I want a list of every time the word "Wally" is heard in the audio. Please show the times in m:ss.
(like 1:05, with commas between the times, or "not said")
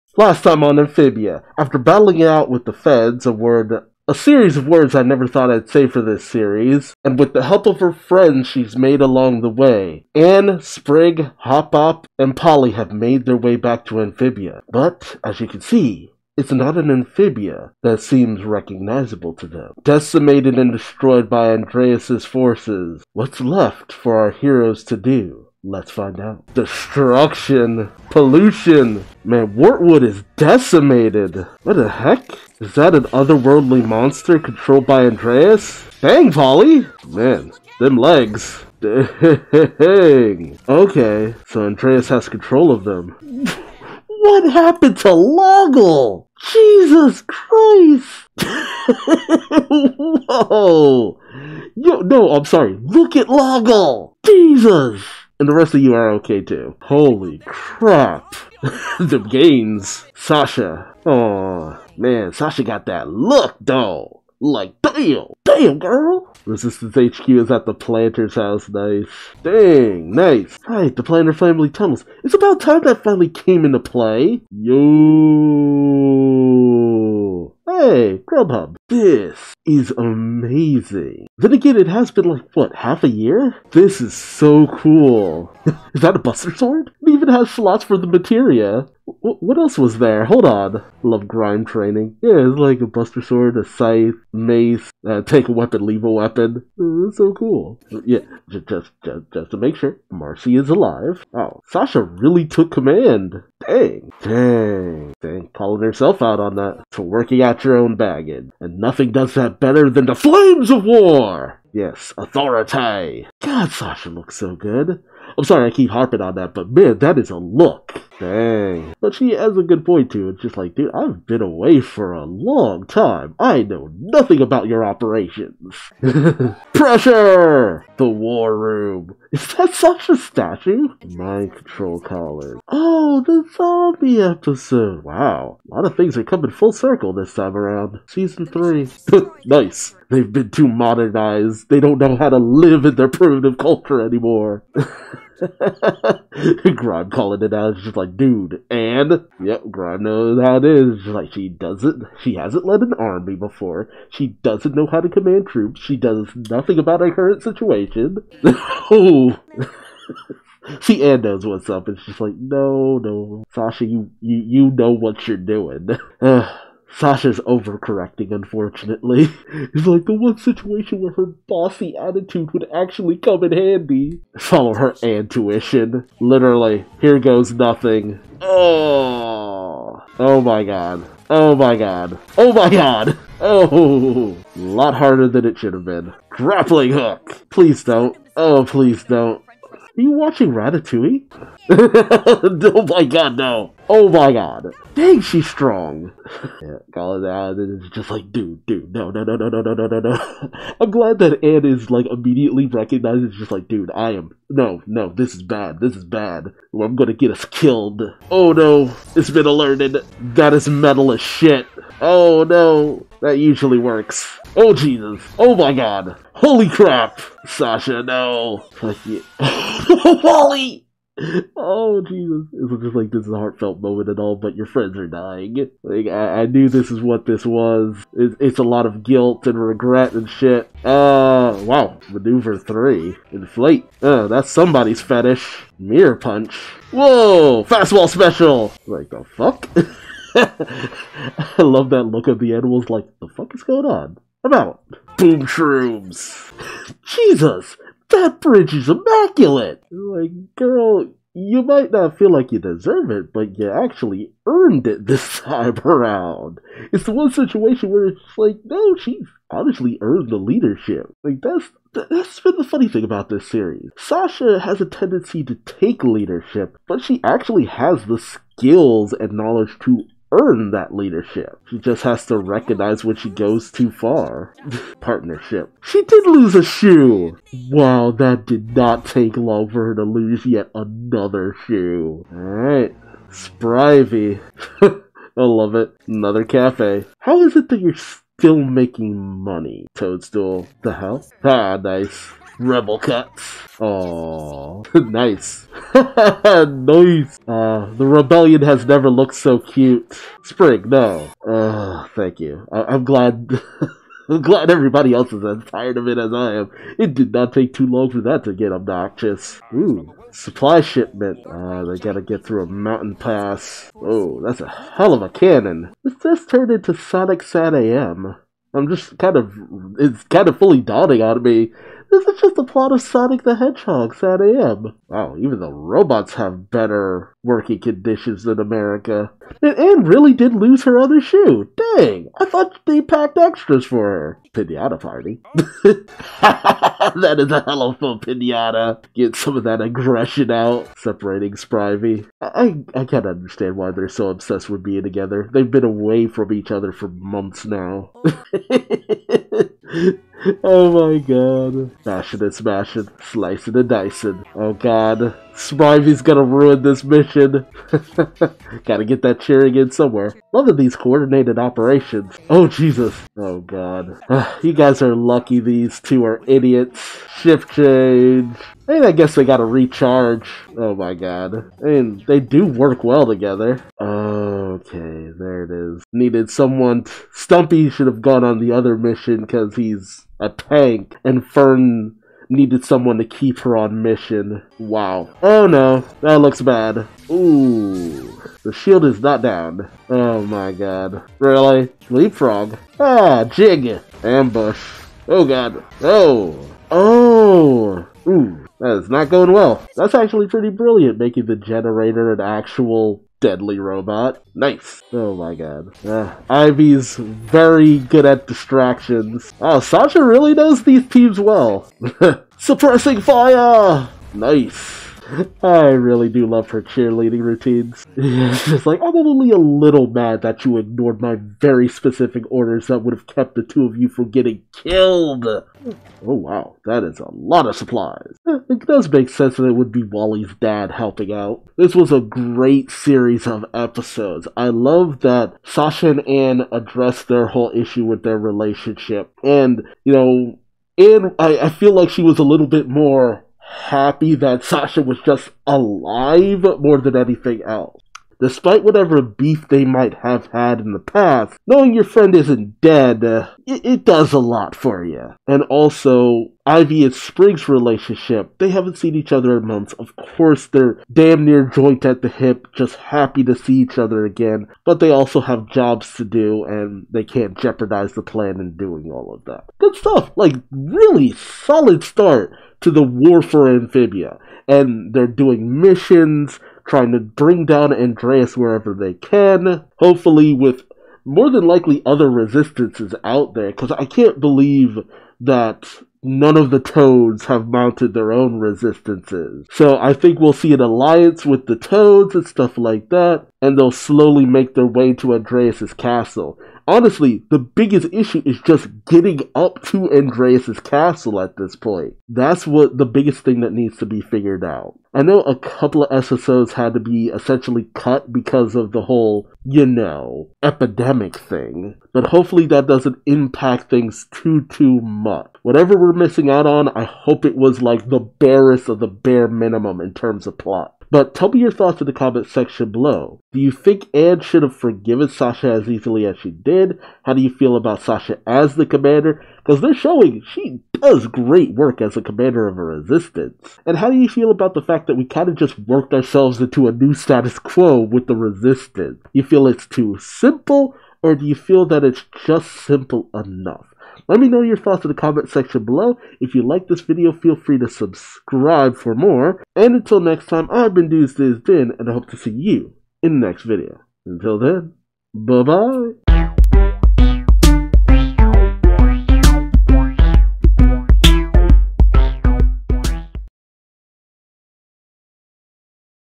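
3:40, 7:10.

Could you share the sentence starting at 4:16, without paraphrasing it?
It's the one situation where it's like, no, she's honestly earned the leadership.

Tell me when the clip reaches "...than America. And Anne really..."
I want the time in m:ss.
5:28.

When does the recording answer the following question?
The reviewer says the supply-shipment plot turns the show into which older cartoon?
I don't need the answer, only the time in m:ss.
5:16.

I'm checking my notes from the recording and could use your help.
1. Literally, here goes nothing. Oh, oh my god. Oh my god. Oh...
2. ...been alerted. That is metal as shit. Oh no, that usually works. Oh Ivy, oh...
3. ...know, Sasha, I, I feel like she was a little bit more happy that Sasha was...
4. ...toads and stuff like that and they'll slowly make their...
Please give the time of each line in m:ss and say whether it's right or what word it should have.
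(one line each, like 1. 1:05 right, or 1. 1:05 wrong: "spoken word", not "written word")
1. 2:56 right
2. 3:29 wrong: "Jesus", not "Ivy"
3. 7:20 wrong: "Anne", not "Sasha"
4. 8:11 right.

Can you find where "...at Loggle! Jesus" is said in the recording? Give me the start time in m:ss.
0:53.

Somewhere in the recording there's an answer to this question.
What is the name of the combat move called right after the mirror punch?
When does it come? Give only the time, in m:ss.
3:57.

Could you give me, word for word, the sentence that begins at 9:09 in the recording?
And until next time, I've been Duuz-Diz-Din, and I hope to see you in the next video.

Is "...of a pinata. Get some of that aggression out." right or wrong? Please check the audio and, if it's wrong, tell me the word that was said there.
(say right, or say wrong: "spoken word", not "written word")
right.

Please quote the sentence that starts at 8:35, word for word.
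Whatever we're missing out on, I hope it was like the barest of the bare minimum in terms of plot.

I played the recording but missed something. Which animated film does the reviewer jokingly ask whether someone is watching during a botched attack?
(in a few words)
Ratatouille.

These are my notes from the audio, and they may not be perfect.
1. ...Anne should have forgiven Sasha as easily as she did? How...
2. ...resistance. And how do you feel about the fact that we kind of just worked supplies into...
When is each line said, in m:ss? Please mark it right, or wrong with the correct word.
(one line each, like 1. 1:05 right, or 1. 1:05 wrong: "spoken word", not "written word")
1. 8:44 right
2. 8:52 wrong: "ourselves", not "supplies".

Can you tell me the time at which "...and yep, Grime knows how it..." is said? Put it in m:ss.
2:28.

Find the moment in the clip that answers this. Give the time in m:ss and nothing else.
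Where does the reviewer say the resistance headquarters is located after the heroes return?
1:07.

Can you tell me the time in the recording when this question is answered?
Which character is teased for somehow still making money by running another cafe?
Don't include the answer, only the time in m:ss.
4:49.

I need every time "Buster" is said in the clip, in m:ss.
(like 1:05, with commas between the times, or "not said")
1:26, 1:32.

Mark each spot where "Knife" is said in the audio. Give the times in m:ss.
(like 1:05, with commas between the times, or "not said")
6:44, 6:54.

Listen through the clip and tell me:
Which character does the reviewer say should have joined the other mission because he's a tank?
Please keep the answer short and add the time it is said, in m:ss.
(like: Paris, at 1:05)
Stumpy, at 6:17.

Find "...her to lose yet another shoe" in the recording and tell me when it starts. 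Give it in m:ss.
4:39.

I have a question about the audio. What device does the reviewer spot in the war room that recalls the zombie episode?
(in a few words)
Mind control collar.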